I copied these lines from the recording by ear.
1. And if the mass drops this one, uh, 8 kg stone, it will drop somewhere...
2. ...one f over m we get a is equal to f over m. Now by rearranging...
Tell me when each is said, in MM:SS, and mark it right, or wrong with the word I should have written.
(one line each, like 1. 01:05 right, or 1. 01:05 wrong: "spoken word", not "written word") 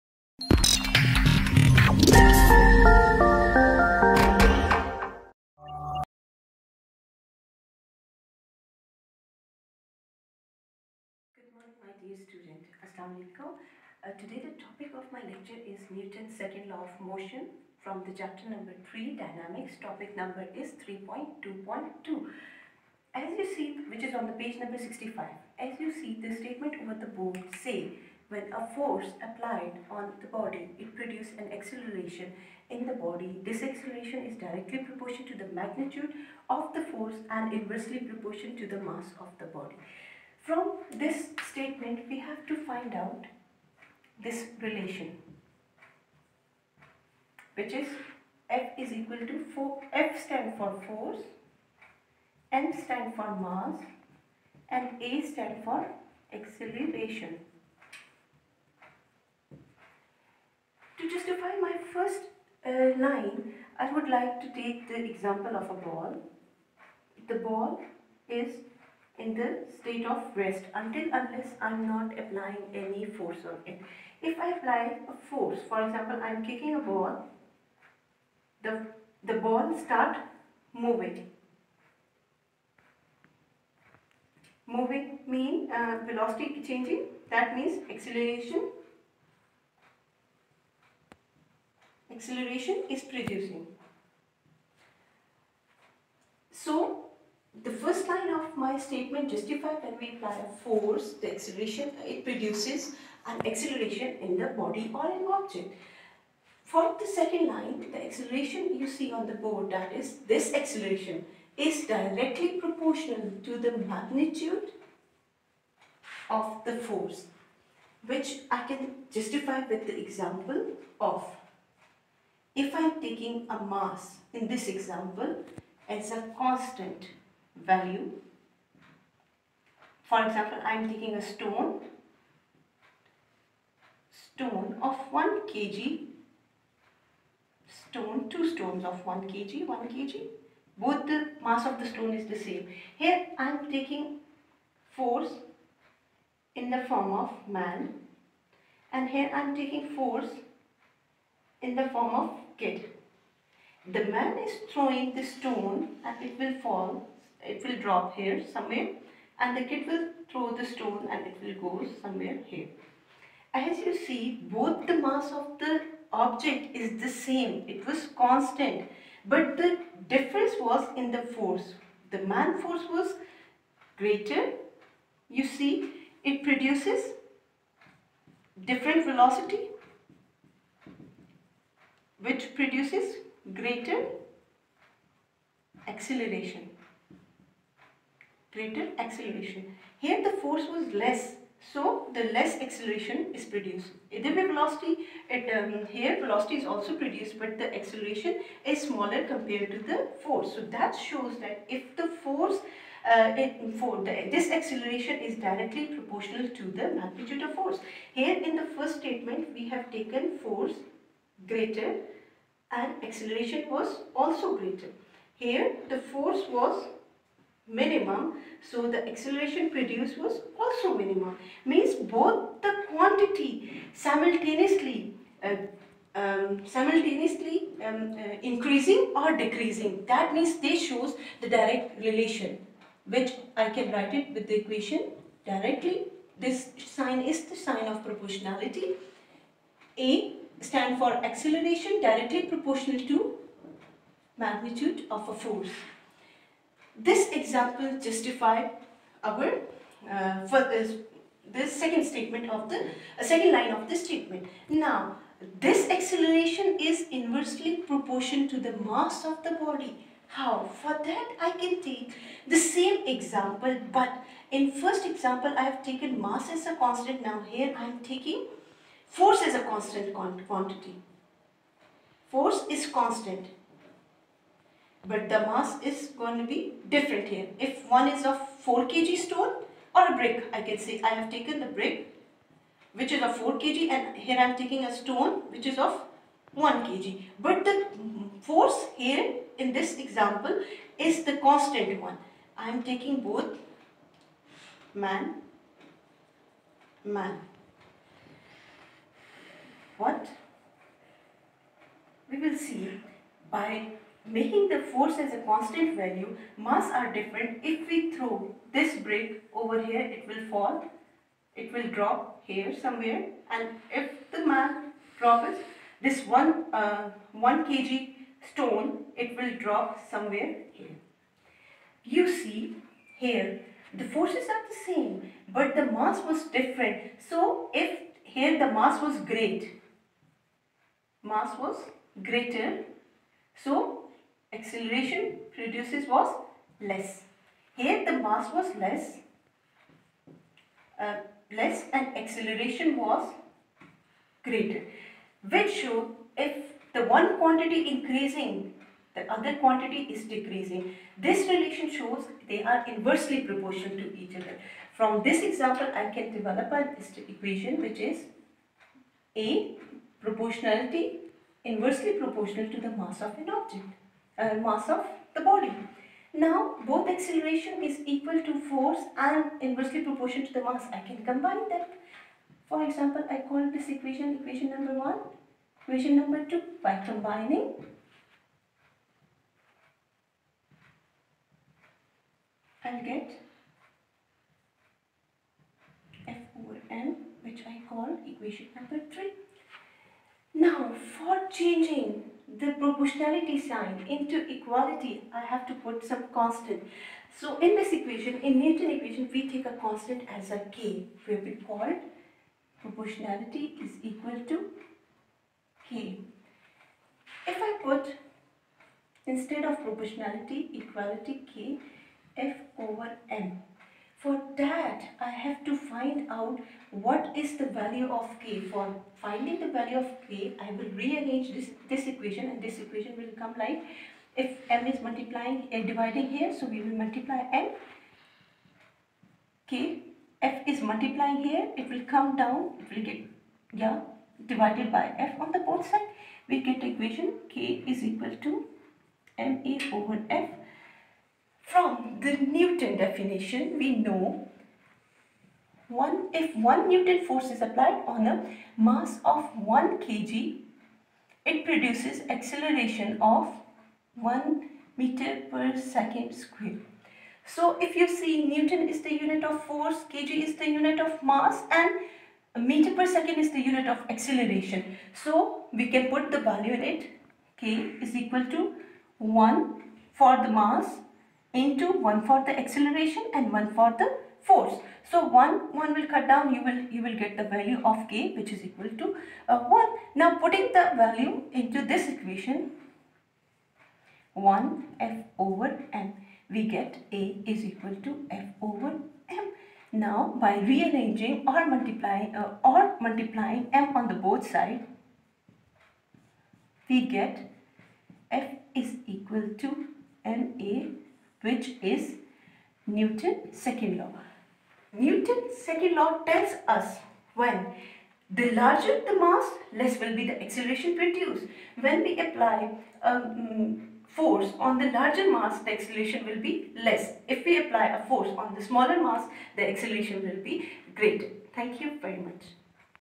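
1. 05:13 wrong: "1", not "8"
2. 08:04 right.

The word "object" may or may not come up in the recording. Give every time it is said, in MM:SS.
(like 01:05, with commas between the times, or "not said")
01:45, 02:46, 06:03.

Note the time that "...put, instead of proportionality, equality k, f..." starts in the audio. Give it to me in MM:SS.
06:47.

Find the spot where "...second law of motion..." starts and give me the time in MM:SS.
00:16.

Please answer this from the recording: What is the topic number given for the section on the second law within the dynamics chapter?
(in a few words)
3.2.2.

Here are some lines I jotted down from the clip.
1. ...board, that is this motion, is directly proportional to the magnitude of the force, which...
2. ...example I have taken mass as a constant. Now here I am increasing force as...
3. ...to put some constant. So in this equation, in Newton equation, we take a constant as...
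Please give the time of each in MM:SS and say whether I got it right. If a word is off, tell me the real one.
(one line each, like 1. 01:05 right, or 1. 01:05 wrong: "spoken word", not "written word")
1. 01:49 wrong: "acceleration", not "motion"
2. 04:25 wrong: "taking", not "increasing"
3. 06:35 right.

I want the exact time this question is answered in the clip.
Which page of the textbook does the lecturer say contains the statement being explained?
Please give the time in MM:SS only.
00:24.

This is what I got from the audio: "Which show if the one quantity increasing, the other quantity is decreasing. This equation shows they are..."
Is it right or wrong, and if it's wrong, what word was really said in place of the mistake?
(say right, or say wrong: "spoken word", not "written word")
wrong: "relation", not "equation".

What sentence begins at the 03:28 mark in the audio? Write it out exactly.
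Here in the first statement we have taken force greater and acceleration was also greater.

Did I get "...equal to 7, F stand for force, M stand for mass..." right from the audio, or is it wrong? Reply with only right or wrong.
wrong.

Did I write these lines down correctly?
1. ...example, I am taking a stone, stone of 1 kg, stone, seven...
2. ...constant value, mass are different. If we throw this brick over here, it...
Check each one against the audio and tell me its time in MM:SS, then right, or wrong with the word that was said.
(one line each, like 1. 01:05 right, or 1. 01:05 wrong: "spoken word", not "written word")
1. 02:10 wrong: "two", not "seven"
2. 05:05 right.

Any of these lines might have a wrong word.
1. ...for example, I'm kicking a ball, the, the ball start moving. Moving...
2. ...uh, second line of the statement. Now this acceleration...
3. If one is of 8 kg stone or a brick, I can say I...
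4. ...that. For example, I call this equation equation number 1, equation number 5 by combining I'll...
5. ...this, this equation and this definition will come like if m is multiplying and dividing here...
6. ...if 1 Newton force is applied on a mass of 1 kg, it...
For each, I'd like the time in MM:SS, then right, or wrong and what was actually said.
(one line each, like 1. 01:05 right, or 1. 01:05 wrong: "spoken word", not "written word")
1. 01:15 right
2. 04:13 right
3. 04:37 wrong: "4", not "8"
4. 06:11 wrong: "2", not "5"
5. 07:01 wrong: "equation", not "definition"
6. 07:26 right.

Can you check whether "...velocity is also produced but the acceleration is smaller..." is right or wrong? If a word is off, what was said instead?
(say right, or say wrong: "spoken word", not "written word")
right.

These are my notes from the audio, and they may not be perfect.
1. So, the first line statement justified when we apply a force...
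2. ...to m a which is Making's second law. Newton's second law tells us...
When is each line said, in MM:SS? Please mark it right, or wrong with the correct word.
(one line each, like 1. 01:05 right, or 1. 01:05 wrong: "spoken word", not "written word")
1. 01:36 right
2. 08:19 wrong: "Newton", not "Making".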